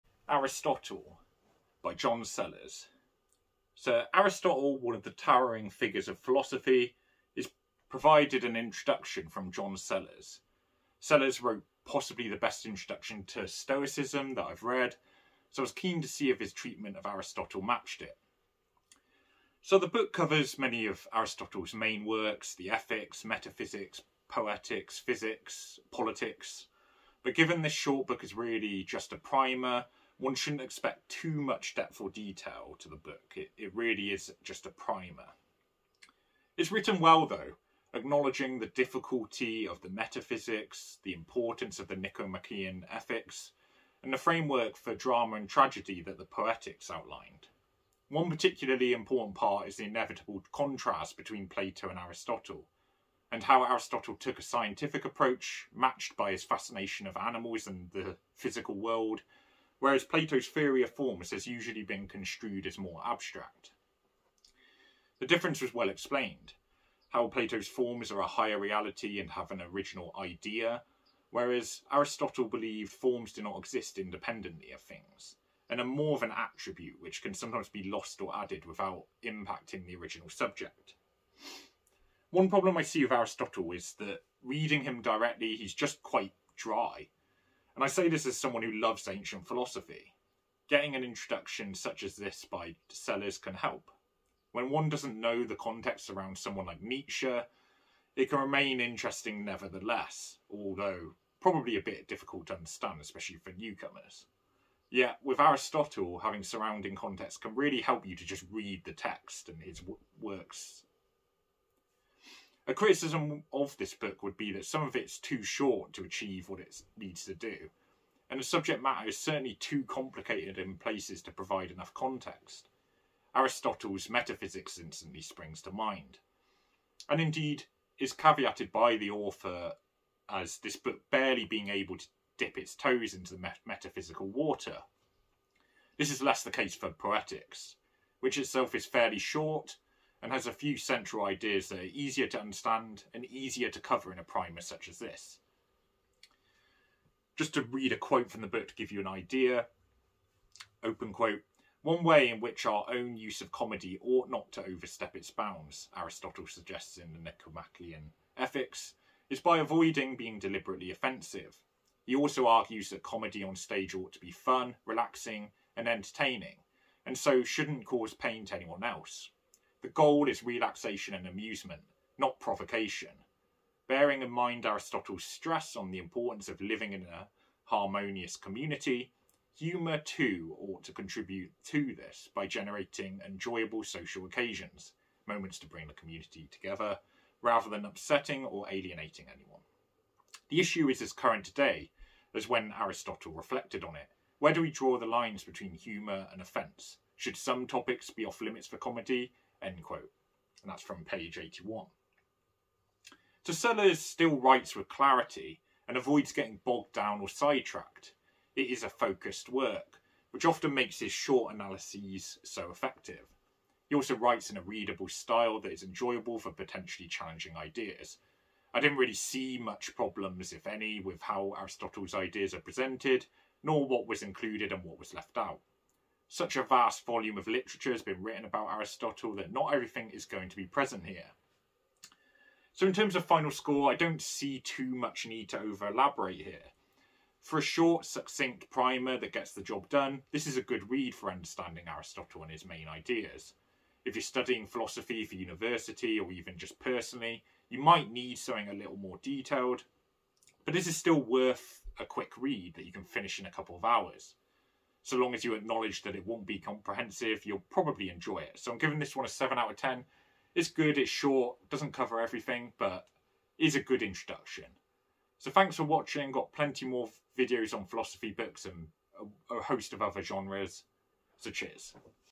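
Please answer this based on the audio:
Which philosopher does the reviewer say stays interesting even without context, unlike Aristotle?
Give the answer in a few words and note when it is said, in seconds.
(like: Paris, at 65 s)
Nietzsche, at 96 s.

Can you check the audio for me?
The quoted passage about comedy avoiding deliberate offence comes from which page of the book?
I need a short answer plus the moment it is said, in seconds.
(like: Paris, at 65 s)
81, at 201 s.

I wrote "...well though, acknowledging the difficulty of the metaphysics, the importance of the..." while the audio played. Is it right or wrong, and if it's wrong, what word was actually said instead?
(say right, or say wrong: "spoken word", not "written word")
right.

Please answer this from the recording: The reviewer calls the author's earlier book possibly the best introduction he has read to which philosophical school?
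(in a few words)
Stoicism.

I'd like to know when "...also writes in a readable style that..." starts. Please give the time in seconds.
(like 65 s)
213 s.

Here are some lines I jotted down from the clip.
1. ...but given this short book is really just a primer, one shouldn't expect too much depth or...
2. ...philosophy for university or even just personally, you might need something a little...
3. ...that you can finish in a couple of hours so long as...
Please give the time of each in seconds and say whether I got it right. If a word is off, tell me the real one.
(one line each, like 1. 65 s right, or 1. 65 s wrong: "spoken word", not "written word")
1. 27 s right
2. 244 s right
3. 252 s right.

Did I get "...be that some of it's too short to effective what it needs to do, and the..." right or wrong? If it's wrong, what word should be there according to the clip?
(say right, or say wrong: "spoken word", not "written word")
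wrong: "achieve", not "effective".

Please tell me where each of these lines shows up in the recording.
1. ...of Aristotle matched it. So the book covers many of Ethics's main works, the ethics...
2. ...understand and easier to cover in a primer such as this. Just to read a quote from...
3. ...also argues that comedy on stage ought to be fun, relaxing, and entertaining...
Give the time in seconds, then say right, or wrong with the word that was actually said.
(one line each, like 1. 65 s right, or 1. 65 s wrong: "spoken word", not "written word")
1. 16 s wrong: "Aristotle", not "Ethics"
2. 142 s right
3. 162 s right.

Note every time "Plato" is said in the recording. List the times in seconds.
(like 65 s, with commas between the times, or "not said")
51 s, 60 s, 67 s.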